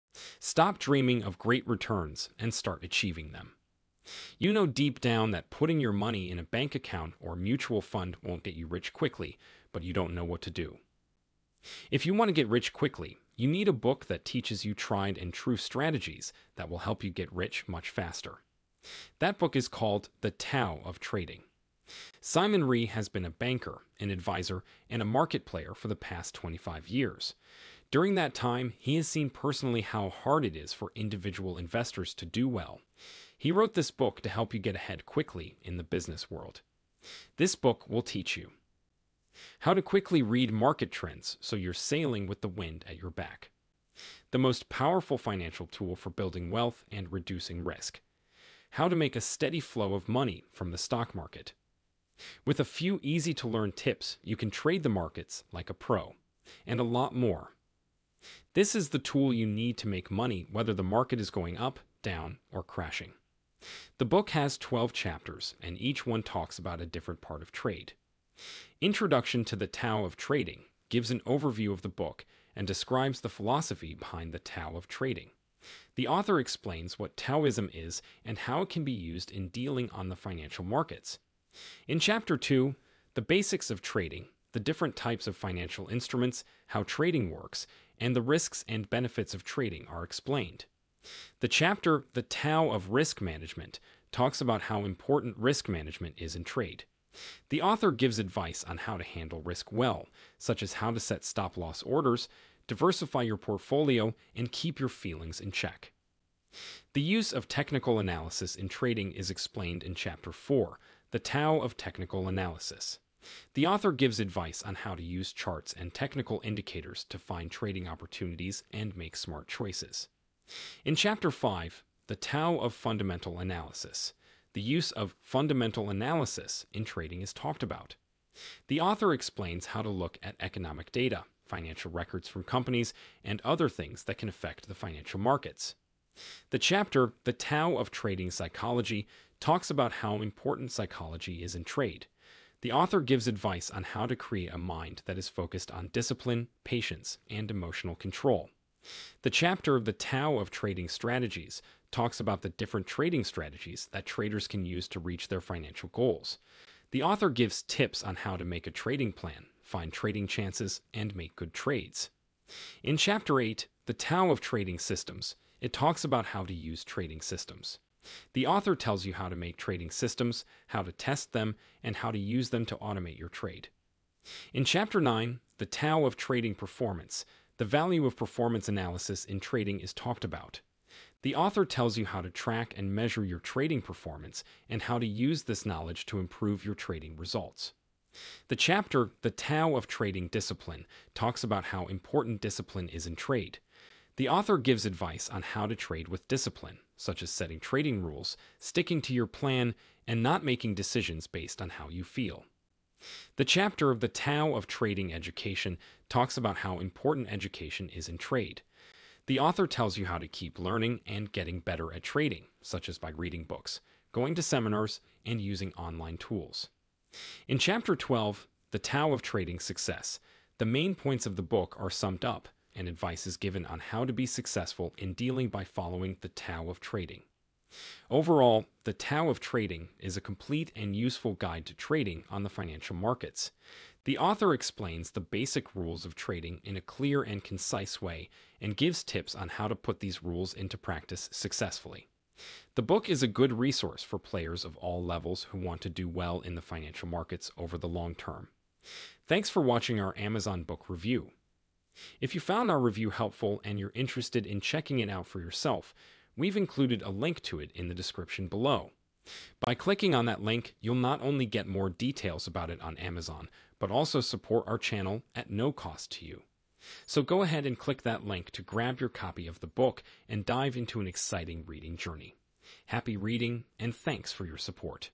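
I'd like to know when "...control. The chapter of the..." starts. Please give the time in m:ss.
2:27.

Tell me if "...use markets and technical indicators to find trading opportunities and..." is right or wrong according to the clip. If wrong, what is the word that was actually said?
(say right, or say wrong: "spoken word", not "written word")
wrong: "charts", not "markets".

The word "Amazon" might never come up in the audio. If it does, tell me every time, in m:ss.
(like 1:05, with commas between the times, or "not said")
4:10, 4:22.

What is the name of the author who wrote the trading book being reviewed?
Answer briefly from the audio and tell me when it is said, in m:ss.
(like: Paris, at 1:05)
Simon Ree, at 0:22.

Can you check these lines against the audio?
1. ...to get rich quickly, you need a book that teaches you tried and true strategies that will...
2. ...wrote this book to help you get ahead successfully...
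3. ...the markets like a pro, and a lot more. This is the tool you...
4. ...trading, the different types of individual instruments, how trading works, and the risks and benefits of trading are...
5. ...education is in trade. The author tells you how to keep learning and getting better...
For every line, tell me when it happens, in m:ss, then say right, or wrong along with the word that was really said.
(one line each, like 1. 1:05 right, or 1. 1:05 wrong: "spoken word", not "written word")
1. 0:12 right
2. 0:33 wrong: "quickly", not "successfully"
3. 0:54 right
4. 1:23 wrong: "financial", not "individual"
5. 3:27 right.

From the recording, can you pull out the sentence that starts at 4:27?
So go ahead and click that link to grab your copy of the book and dive into an exciting reading journey.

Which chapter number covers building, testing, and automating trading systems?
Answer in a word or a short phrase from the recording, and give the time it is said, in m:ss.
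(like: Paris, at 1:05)
8, at 2:43.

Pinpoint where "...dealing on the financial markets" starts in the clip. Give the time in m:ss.
1:19.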